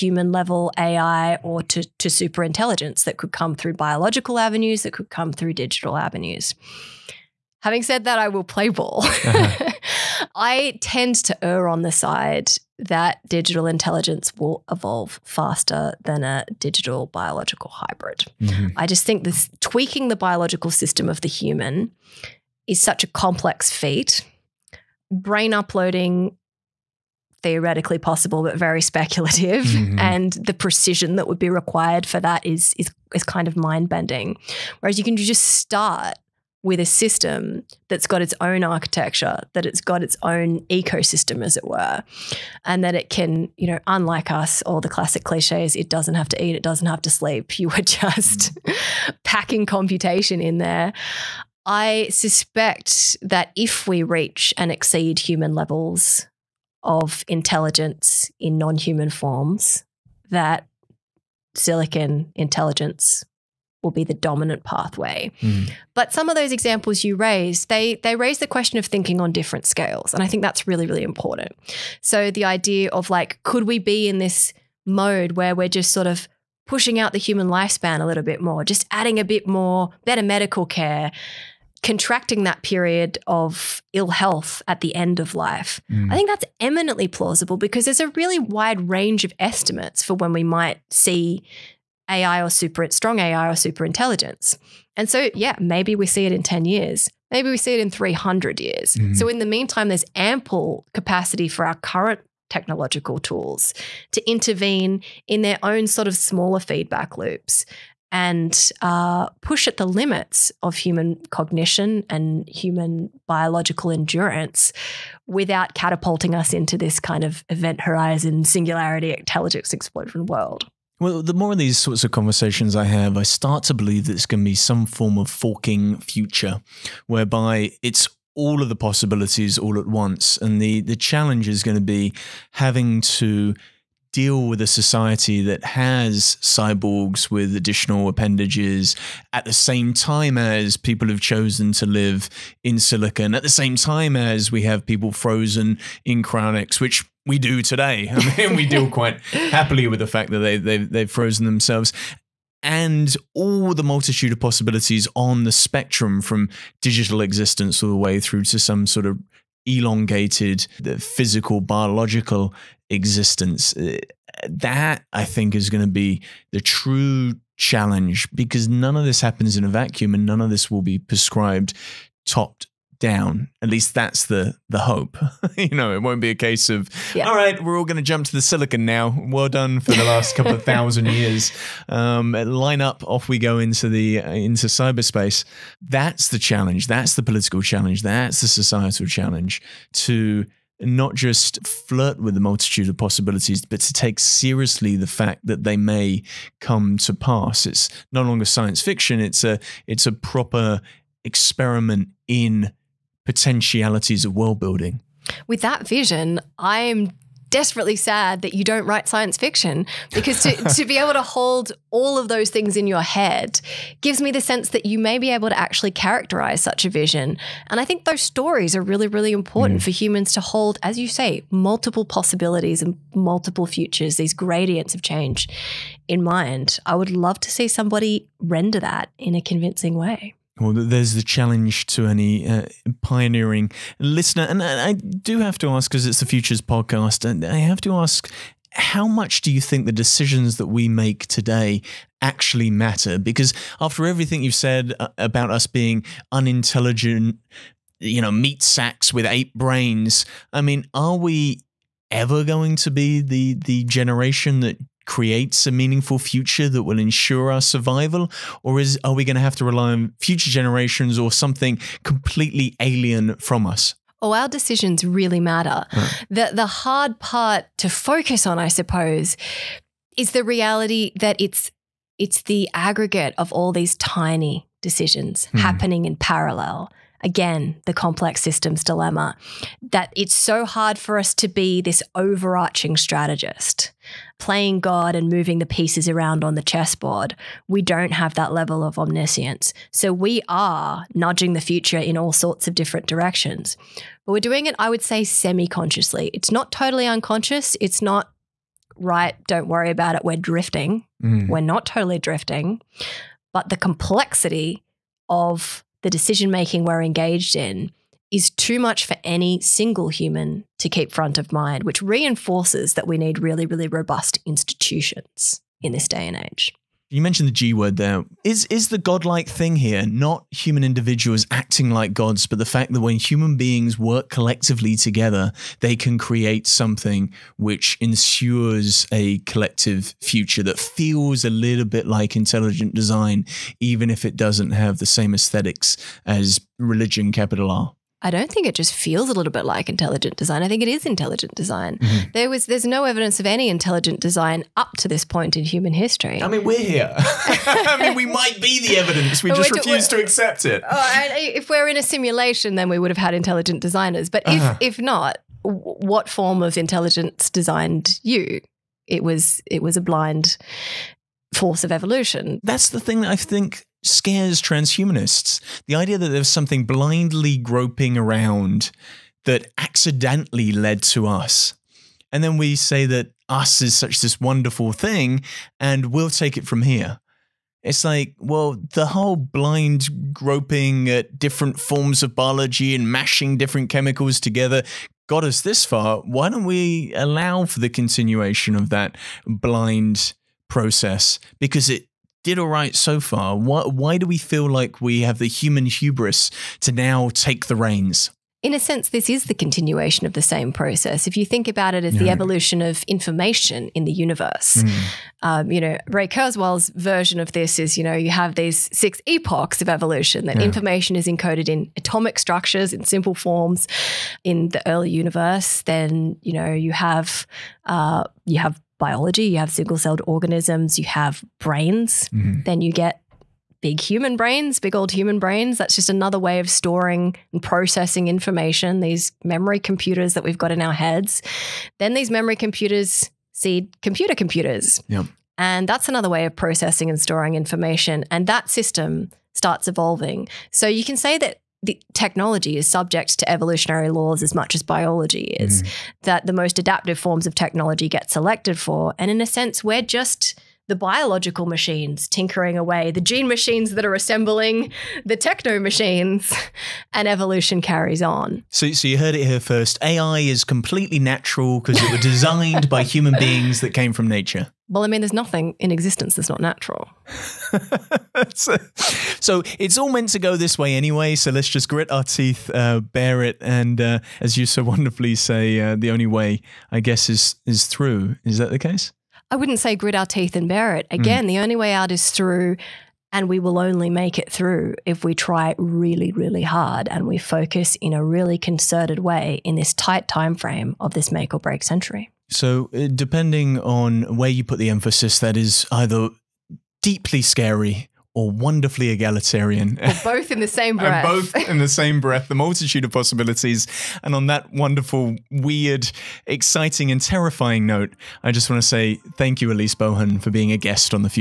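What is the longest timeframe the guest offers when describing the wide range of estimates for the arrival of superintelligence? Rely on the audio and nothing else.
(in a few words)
300 years.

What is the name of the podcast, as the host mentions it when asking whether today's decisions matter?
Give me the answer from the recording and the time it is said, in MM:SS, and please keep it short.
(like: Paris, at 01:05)
Futures podcast, at 03:56.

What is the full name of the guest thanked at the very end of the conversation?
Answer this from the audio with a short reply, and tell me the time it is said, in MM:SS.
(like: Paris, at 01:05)
Elise Bohan, at 08:29.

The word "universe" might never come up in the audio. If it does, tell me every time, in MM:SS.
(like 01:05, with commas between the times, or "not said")
06:44, 06:55.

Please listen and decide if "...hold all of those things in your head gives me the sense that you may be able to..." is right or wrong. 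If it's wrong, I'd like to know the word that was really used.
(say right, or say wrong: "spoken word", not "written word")
right.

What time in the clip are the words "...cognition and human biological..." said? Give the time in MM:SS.
01:51.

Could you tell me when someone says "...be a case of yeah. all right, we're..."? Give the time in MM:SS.
02:56.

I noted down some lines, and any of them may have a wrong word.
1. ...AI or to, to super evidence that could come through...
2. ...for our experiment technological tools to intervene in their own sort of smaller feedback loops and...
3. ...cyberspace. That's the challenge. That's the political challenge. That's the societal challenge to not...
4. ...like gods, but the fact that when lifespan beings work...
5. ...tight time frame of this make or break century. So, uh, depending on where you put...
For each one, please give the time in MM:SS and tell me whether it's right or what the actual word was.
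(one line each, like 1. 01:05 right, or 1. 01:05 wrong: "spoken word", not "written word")
1. 00:00 wrong: "intelligence", not "evidence"
2. 01:41 wrong: "current", not "experiment"
3. 03:04 right
4. 05:21 wrong: "human", not "lifespan"
5. 08:09 right.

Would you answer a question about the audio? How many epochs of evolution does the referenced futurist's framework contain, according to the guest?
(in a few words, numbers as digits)
6.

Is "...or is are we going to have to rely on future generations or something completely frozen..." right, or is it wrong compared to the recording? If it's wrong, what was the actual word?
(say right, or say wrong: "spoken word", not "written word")
wrong: "alien", not "frozen".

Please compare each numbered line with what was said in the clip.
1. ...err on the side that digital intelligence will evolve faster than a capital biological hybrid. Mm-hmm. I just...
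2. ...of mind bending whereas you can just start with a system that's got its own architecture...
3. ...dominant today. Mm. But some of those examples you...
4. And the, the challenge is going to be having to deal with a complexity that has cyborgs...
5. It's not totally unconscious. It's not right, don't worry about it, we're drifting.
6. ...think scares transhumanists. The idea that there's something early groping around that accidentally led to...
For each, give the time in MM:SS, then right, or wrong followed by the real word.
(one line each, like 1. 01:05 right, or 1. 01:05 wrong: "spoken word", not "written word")
1. 00:11 wrong: "digital", not "capital"
2. 00:33 right
3. 01:04 wrong: "pathway", not "today"
4. 02:10 wrong: "society", not "complexity"
5. 04:56 right
6. 06:03 wrong: "blindly", not "early".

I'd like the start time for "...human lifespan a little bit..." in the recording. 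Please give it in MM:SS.
01:17.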